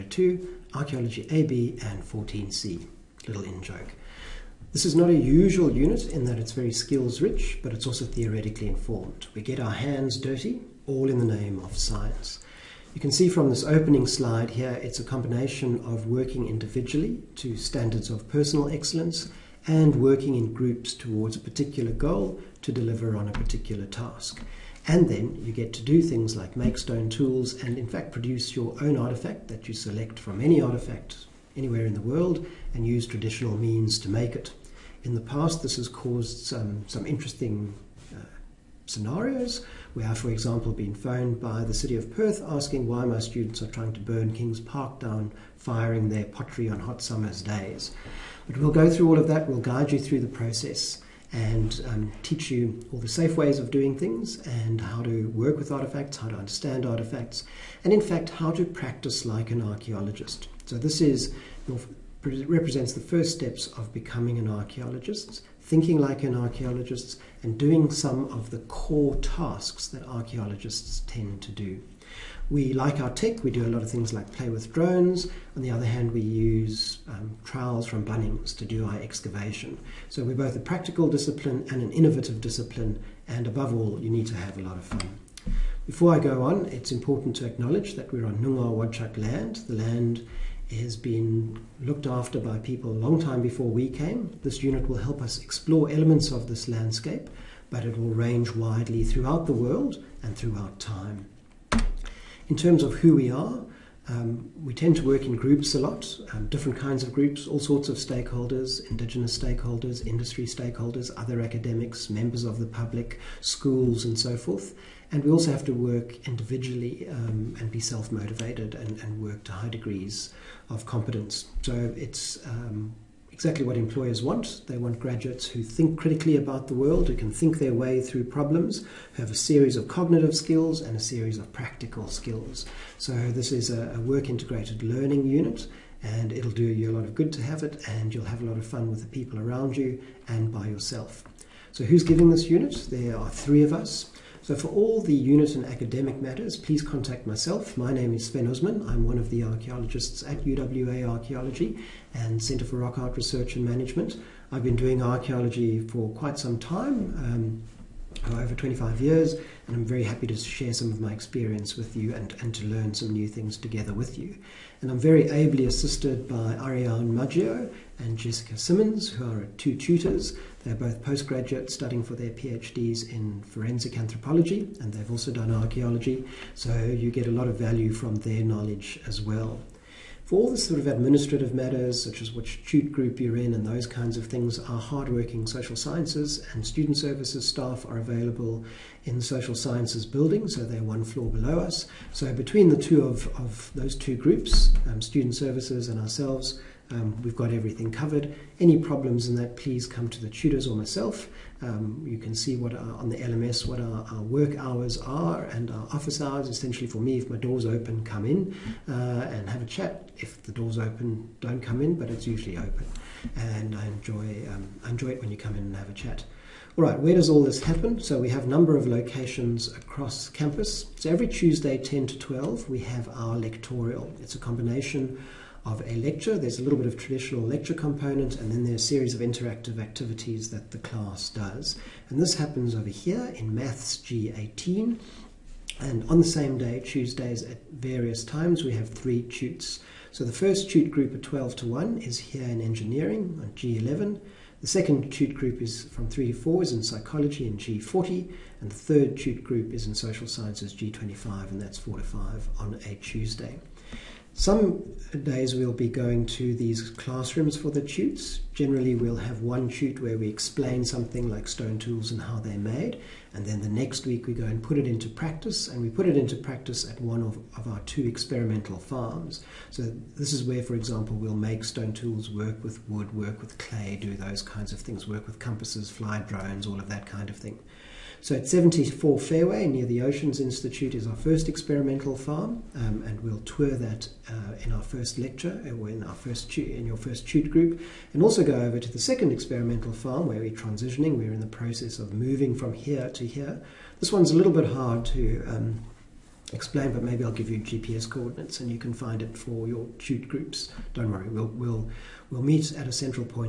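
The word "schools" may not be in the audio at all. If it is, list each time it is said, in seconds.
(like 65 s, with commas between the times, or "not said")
113 s.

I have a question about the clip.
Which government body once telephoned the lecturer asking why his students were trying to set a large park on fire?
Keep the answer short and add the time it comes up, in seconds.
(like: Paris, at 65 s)
City of Perth, at 41 s.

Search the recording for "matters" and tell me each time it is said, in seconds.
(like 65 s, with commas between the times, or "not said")
146 s, 181 s.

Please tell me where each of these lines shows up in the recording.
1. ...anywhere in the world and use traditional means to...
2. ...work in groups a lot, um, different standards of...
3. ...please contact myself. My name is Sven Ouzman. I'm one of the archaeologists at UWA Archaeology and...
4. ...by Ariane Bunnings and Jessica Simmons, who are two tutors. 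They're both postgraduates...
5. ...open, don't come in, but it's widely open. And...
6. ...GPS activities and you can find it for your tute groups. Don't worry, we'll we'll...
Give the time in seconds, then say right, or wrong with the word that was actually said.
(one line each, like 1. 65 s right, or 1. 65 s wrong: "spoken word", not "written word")
1. 31 s right
2. 105 s wrong: "kinds", not "standards"
3. 146 s right
4. 166 s wrong: "Maggio", not "Bunnings"
5. 210 s wrong: "usually", not "widely"
6. 297 s wrong: "coordinates", not "activities".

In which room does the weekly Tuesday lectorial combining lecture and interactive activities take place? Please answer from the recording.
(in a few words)
Maths G18.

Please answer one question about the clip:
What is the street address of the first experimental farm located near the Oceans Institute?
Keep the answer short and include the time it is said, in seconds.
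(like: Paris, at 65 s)
74 Fairway, at 278 s.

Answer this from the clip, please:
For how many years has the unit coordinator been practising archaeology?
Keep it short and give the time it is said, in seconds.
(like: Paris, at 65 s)
over 25 years, at 158 s.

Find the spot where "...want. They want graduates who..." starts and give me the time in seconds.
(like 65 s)
124 s.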